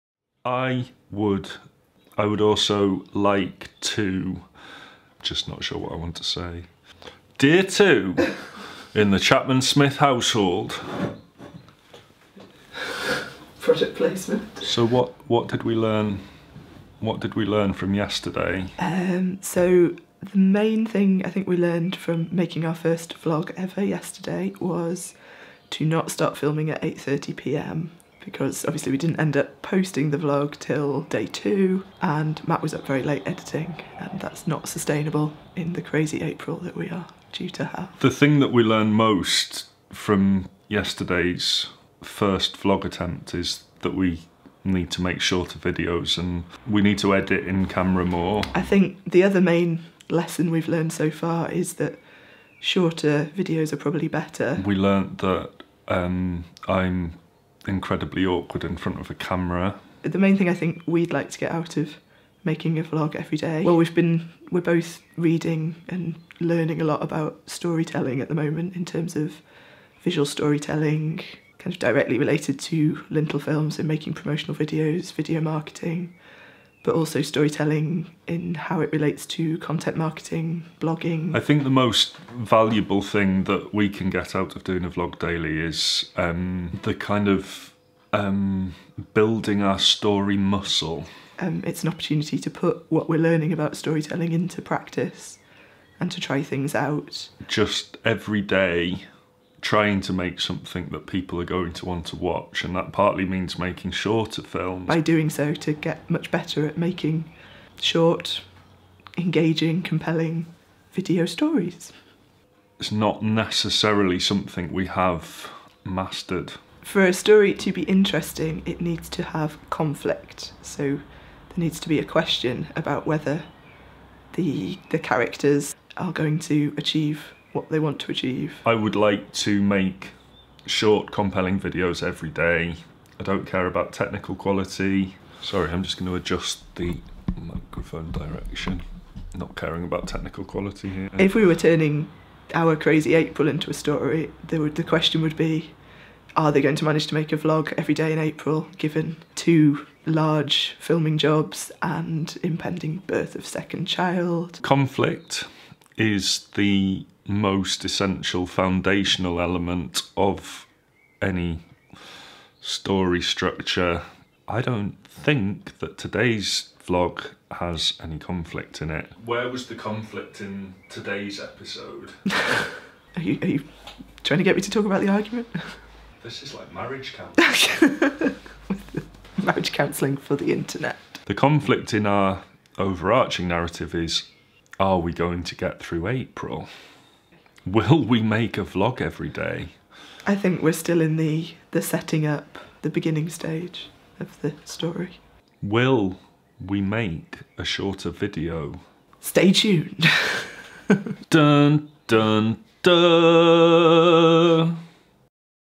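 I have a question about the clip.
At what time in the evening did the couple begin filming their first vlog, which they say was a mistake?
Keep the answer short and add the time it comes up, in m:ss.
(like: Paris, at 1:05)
8:30 p.m., at 0:26.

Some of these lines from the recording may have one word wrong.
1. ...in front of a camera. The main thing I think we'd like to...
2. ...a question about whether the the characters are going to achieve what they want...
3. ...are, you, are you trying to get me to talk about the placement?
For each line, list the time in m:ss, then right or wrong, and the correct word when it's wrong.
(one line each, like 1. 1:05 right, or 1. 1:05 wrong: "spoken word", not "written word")
1. 0:58 right
2. 2:01 right
3. 2:53 wrong: "argument", not "placement".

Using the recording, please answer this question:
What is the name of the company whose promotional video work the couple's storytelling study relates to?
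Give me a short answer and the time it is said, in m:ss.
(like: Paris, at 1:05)
Lintel Films, at 1:13.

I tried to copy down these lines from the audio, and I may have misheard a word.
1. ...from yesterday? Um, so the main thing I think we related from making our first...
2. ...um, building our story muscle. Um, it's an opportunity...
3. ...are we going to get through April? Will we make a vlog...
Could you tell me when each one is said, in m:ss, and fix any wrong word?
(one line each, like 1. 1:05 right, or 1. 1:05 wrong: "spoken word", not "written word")
1. 0:17 wrong: "learned", not "related"
2. 1:28 right
3. 3:04 right.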